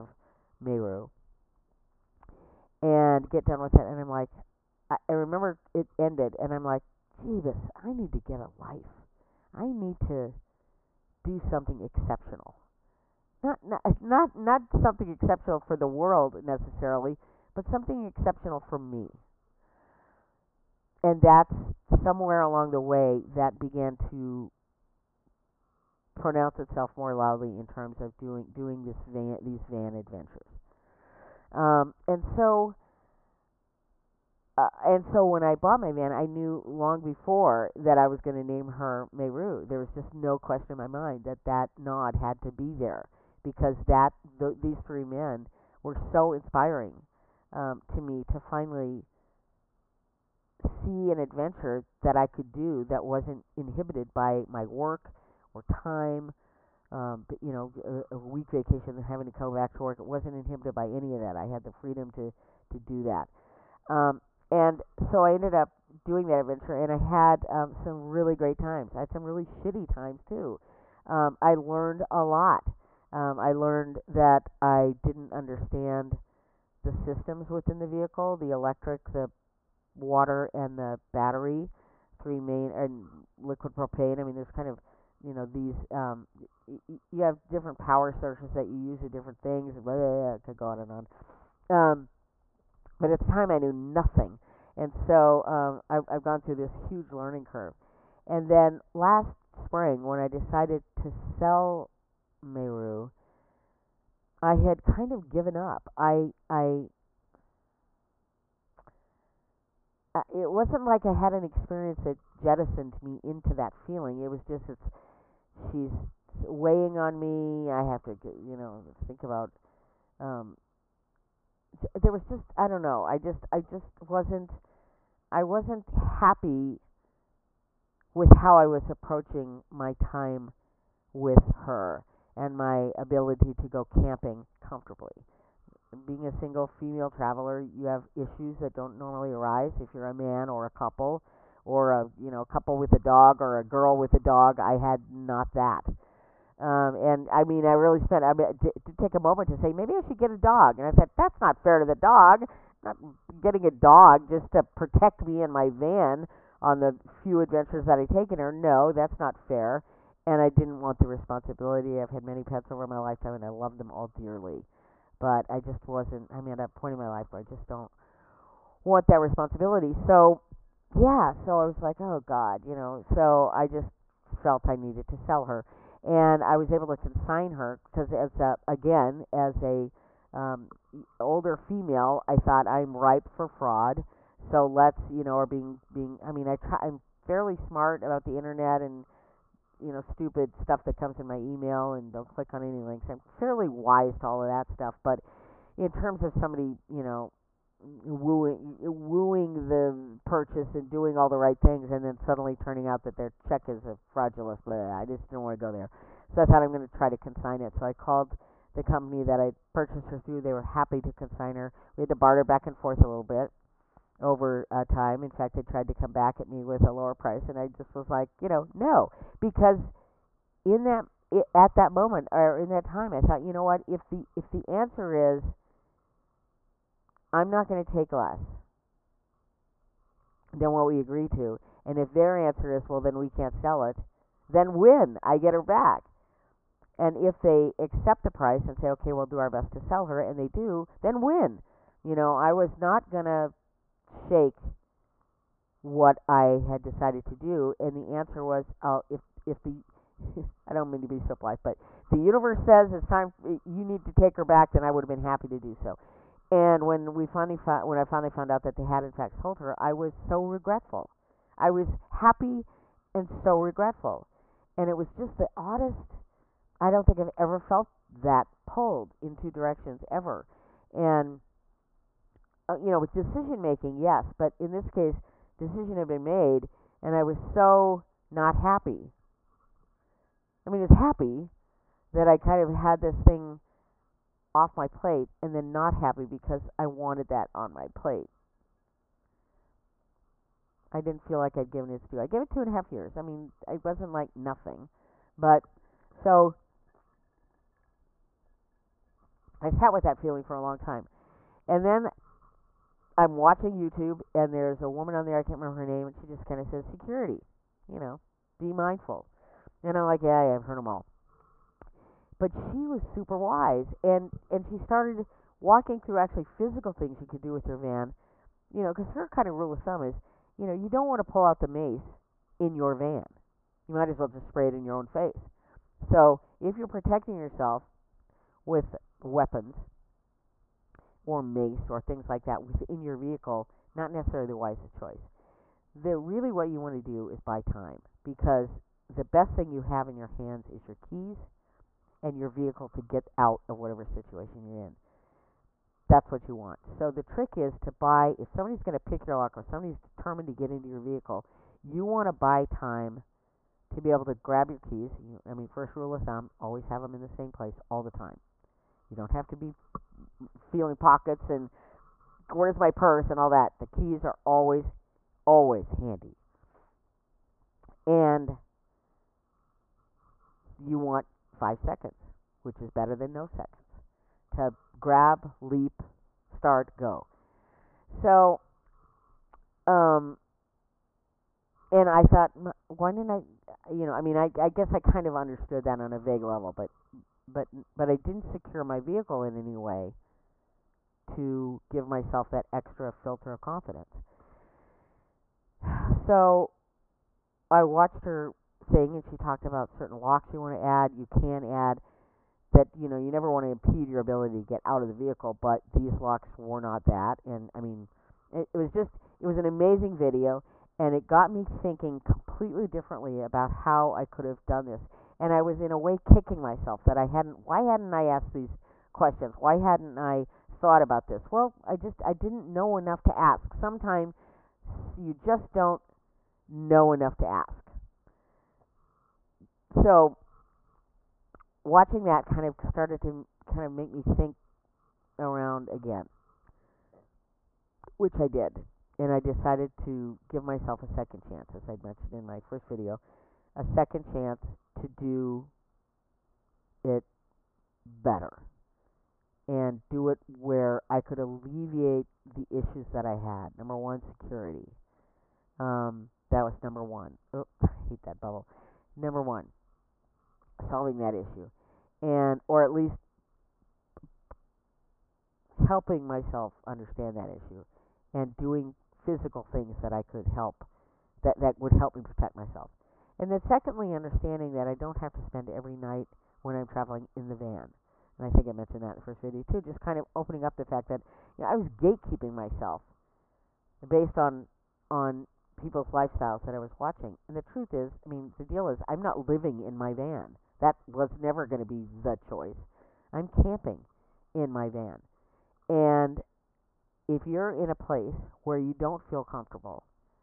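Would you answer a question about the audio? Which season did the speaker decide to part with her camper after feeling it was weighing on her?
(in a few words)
spring.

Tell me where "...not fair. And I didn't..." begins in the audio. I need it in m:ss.
2:39.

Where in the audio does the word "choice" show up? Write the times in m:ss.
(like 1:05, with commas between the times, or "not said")
5:34, 8:12.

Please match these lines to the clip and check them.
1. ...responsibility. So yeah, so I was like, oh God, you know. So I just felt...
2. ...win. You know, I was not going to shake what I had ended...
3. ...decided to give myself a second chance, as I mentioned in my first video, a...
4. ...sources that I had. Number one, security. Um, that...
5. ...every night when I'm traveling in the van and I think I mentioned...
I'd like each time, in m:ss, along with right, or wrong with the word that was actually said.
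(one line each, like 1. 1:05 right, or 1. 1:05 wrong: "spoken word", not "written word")
1. 2:49 right
2. 4:01 wrong: "decided", not "ended"
3. 7:19 right
4. 7:32 wrong: "issues", not "sources"
5. 7:55 right.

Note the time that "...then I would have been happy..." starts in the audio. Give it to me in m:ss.
4:14.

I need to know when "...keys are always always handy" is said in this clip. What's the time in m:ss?
6:03.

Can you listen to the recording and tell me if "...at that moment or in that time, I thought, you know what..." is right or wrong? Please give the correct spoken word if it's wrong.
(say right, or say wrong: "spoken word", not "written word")
right.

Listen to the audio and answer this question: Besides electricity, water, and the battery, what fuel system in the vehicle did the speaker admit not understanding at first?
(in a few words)
liquid propane.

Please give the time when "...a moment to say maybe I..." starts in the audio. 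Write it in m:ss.
2:29.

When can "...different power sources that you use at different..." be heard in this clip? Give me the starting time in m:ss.
1:27.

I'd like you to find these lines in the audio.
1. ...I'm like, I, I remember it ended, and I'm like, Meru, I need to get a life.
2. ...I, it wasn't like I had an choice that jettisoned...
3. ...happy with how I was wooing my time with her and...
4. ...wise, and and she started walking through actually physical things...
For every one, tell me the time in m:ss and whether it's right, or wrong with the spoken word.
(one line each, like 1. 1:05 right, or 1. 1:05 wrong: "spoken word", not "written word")
1. 0:04 wrong: "Jeebus", not "Meru"
2. 1:46 wrong: "experience", not "choice"
3. 2:05 wrong: "approaching", not "wooing"
4. 5:13 right.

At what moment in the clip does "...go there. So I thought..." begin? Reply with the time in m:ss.
3:25.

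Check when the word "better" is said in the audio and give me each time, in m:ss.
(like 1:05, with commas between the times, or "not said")
6:12, 7:28.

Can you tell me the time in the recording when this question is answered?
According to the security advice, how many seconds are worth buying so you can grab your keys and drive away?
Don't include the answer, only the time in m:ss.
6:11.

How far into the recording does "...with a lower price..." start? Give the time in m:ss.
3:36.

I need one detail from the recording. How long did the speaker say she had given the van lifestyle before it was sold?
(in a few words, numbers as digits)
two and a half years.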